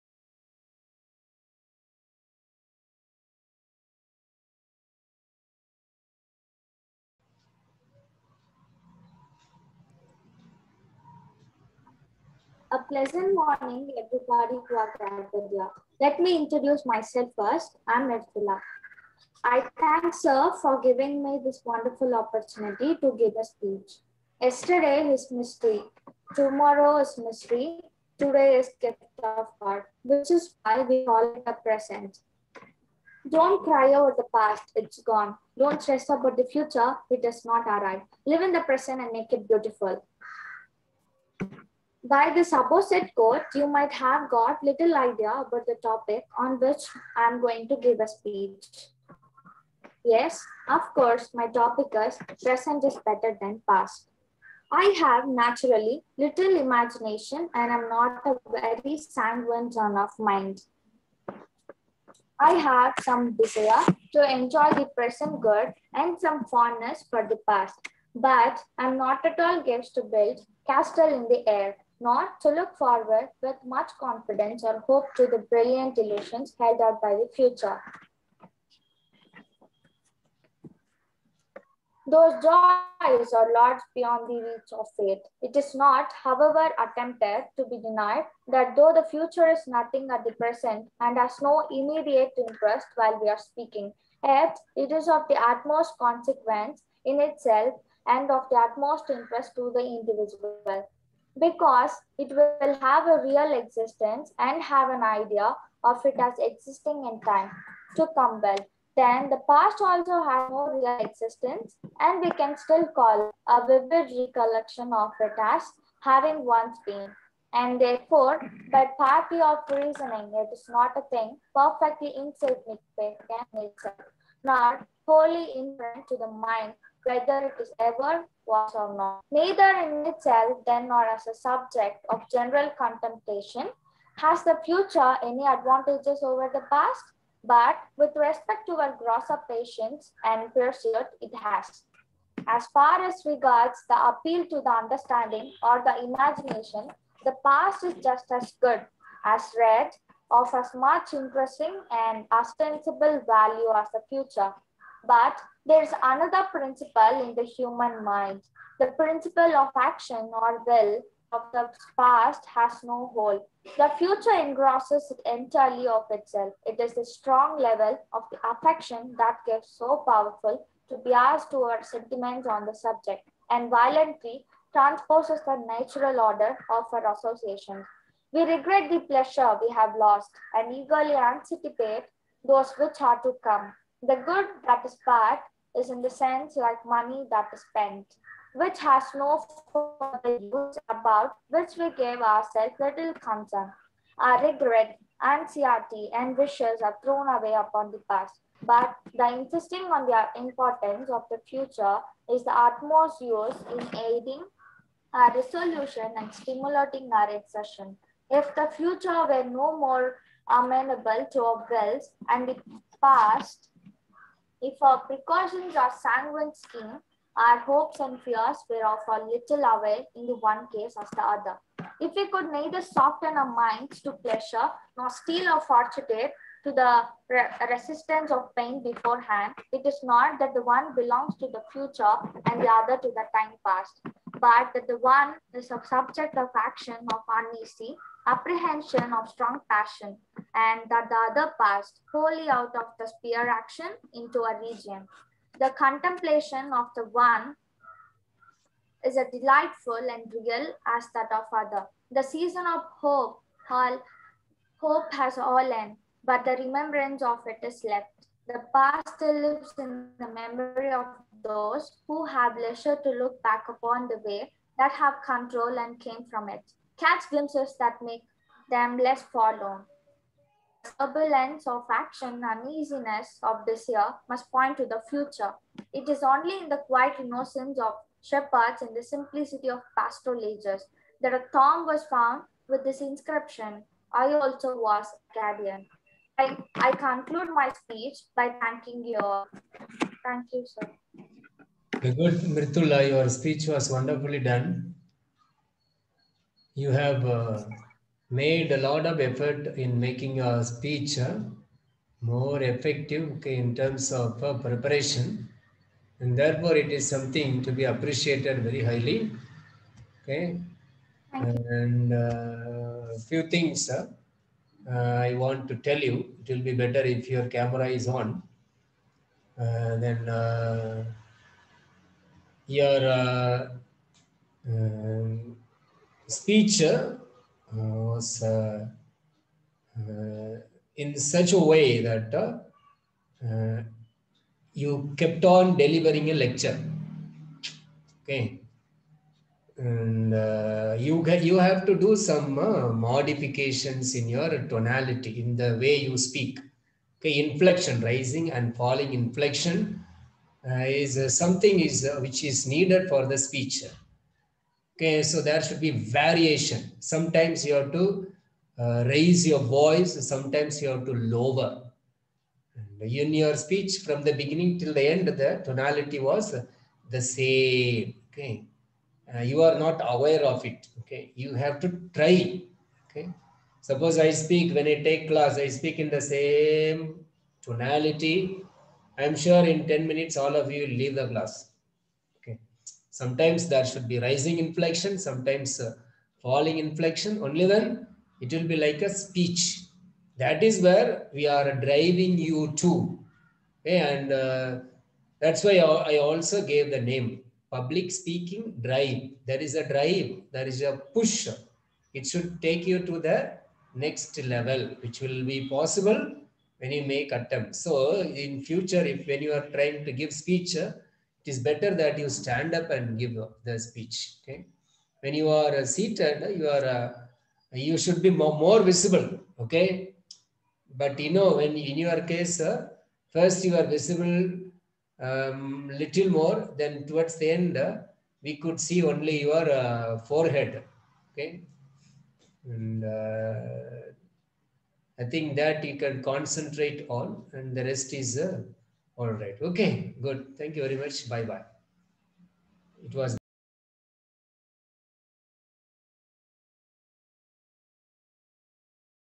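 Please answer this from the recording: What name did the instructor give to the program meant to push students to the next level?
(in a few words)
public speaking drive.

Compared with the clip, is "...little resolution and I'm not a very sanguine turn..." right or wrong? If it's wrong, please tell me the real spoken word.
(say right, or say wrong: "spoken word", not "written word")
wrong: "imagination", not "resolution".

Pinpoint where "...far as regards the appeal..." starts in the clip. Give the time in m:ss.
2:22.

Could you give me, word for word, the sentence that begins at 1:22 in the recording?
Those joys are large beyond the reach of fate.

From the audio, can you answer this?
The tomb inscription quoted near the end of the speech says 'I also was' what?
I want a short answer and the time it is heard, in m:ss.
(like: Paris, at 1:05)
Arcadian, at 4:45.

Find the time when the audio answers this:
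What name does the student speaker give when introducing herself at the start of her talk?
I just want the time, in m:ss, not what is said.
0:18.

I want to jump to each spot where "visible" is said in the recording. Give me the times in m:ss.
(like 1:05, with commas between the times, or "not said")
6:58, 7:03.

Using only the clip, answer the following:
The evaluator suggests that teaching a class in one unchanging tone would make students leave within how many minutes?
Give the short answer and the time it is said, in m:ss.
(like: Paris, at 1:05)
10, at 6:19.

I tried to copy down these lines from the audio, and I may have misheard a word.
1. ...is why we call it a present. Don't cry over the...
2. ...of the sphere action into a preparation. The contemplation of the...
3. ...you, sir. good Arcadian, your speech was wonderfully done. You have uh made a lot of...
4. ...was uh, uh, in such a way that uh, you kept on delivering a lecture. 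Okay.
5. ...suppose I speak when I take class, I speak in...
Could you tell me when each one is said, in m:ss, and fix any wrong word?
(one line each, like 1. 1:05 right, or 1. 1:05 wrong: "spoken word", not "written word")
1. 0:30 right
2. 4:02 wrong: "region", not "preparation"
3. 4:50 wrong: "Mritula", not "Arcadian"
4. 5:27 right
5. 6:13 right.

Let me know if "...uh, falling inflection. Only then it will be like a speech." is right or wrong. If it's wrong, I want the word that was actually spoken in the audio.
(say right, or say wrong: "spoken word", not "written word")
right.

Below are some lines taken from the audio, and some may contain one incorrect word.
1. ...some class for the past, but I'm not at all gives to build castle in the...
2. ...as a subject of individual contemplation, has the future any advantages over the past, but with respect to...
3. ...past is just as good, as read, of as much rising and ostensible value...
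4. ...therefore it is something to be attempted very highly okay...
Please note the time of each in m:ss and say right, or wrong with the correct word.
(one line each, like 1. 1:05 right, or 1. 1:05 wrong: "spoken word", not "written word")
1. 1:06 wrong: "fondness", not "class"
2. 2:11 wrong: "general", not "individual"
3. 2:27 wrong: "interesting", not "rising"
4. 5:06 wrong: "appreciated", not "attempted".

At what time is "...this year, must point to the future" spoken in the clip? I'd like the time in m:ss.
4:33.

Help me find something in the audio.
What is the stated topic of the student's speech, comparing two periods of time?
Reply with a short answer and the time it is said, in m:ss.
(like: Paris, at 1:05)
Present is better than past, at 0:52.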